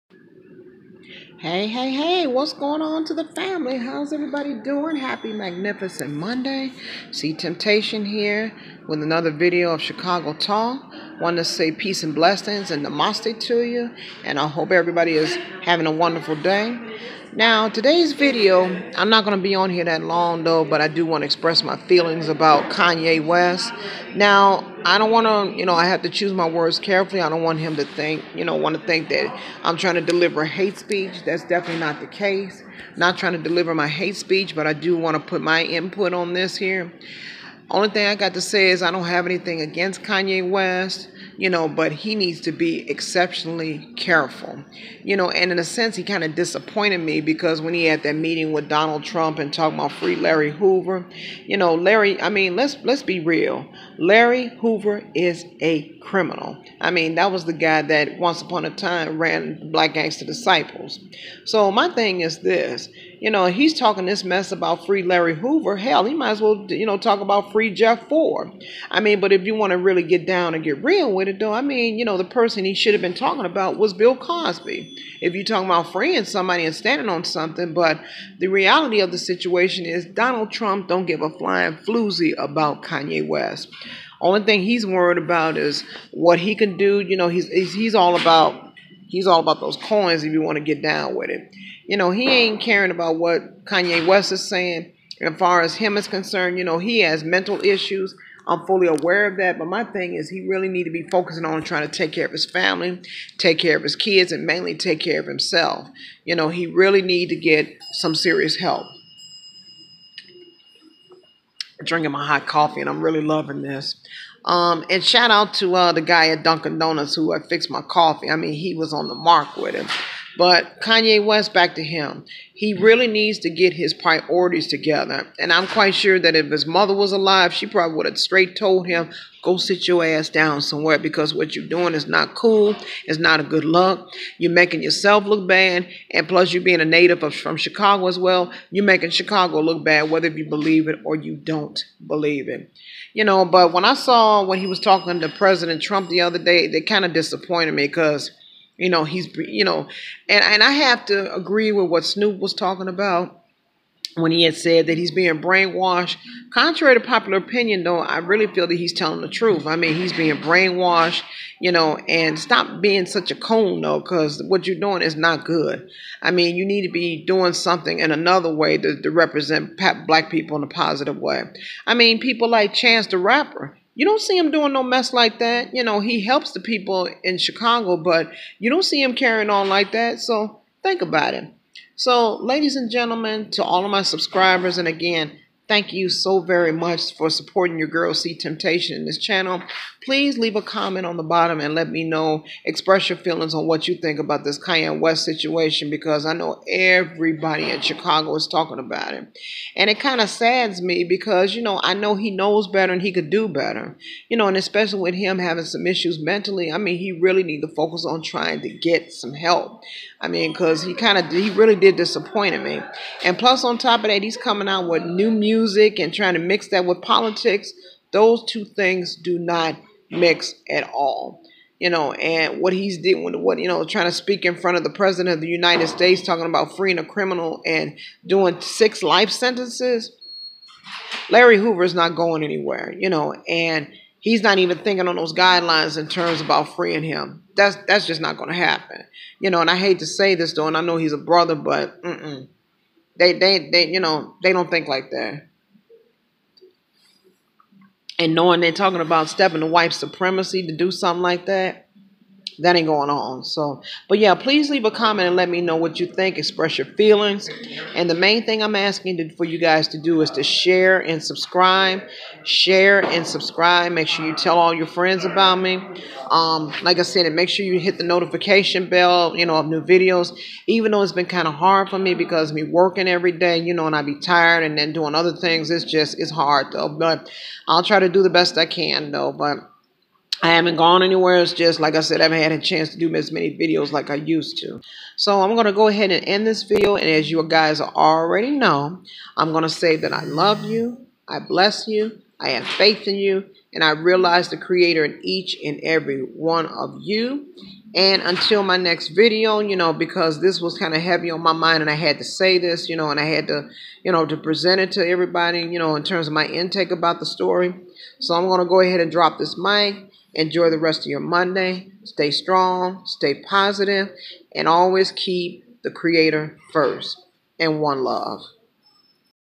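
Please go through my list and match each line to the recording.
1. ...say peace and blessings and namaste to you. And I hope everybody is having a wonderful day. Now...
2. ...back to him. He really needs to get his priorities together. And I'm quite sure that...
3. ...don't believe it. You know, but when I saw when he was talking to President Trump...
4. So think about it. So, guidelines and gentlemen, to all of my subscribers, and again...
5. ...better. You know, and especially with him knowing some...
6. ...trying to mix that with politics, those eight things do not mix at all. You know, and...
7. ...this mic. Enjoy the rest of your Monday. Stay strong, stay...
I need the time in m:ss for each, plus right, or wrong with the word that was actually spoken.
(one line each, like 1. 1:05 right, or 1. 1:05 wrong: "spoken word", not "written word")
1. 0:11 right
2. 2:01 right
3. 2:21 right
4. 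3:00 wrong: "ladies", not "guidelines"
5. 3:23 wrong: "having", not "knowing"
6. 3:36 wrong: "two", not "eight"
7. 5:09 right.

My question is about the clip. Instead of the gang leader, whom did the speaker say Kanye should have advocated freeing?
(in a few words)
Bill Cosby.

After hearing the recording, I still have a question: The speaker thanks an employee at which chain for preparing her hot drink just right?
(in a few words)
Dunkin' Donuts.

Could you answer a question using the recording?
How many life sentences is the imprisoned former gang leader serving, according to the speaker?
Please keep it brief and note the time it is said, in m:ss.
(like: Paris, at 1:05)
6, at 3:48.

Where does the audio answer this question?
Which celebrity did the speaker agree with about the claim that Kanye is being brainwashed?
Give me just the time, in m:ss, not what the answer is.
2:32.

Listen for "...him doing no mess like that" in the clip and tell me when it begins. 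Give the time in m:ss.
2:54.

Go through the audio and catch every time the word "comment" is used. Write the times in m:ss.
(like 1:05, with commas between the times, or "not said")
3:10, 4:14.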